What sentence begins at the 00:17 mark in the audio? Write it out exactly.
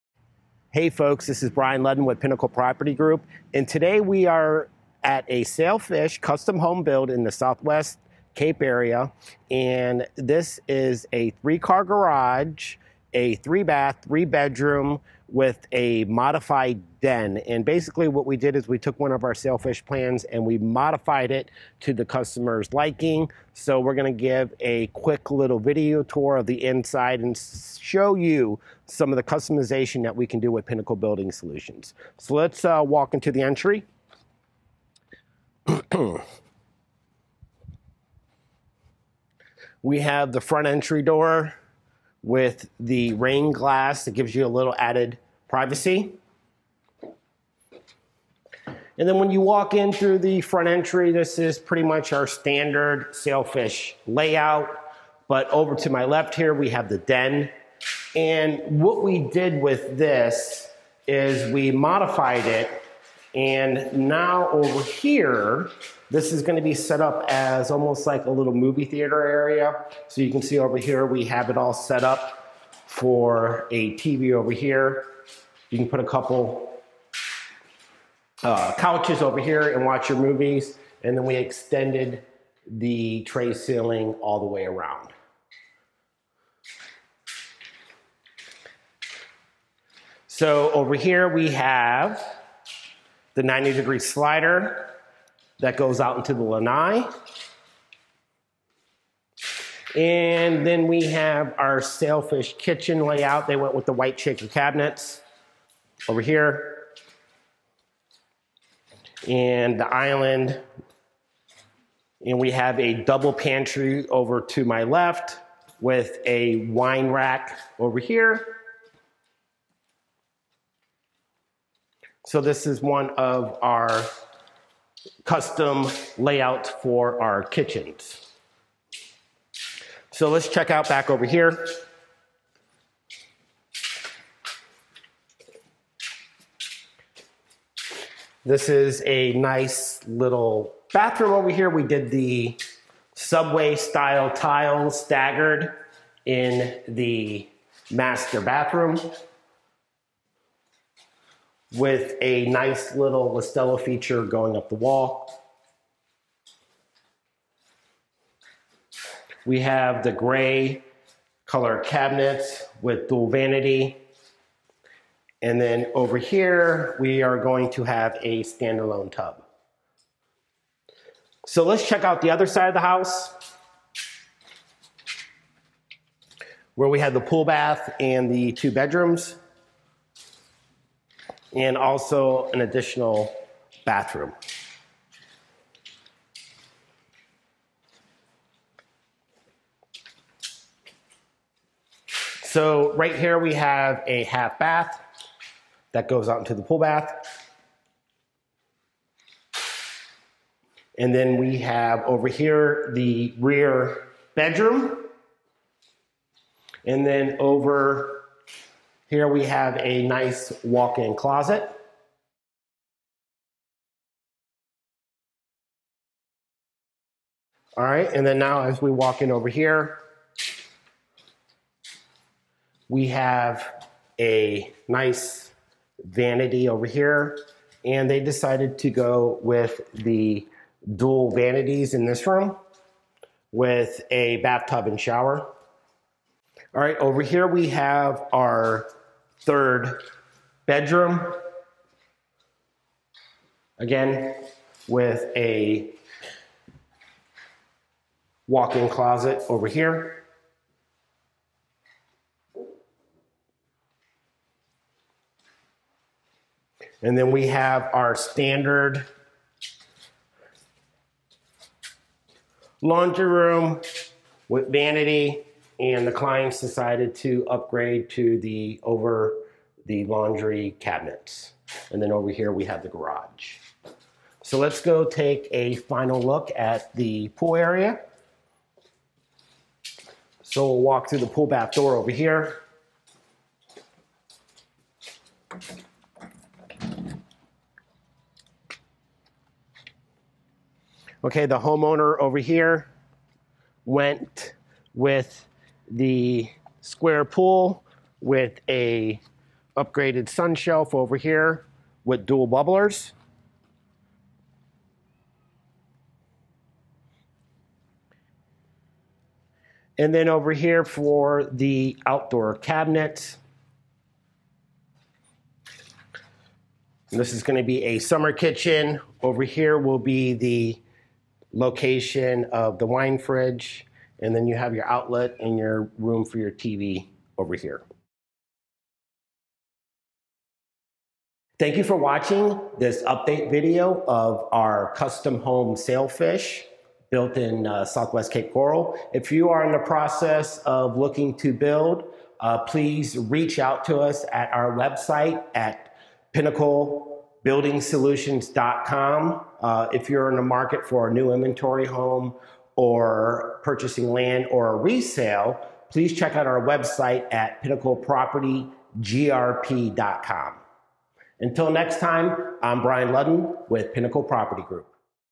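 And basically, what we did is we took one of our sailfish plans and we modified it to the customer's liking.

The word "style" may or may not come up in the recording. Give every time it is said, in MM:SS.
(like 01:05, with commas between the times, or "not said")
02:23.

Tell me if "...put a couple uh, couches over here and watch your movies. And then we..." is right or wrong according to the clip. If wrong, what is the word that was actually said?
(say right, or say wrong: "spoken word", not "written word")
right.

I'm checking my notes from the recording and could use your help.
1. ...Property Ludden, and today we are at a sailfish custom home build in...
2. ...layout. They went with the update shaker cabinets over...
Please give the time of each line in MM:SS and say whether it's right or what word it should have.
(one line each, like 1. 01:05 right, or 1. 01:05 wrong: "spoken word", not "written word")
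1. 00:02 wrong: "Group", not "Ludden"
2. 01:43 wrong: "white", not "update".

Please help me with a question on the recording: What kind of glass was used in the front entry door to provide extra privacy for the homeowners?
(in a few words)
rain glass.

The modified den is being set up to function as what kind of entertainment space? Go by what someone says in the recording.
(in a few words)
movie theater.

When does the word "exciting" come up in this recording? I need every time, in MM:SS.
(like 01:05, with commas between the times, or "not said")
not said.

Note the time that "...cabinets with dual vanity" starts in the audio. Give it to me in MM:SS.
02:41.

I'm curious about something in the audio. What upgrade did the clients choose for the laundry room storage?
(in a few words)
over the laundry cabinets.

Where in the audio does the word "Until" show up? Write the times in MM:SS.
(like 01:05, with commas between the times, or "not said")
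06:01.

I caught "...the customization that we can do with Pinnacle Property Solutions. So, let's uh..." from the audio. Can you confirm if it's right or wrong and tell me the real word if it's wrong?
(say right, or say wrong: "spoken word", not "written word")
wrong: "Building", not "Property".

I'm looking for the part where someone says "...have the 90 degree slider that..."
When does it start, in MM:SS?
01:31.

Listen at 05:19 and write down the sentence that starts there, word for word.
Over here will be the location of the wine fridge.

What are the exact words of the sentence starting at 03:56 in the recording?
All right, over here we have our third bedroom.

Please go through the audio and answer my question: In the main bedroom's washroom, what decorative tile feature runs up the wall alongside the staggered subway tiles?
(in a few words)
Listello.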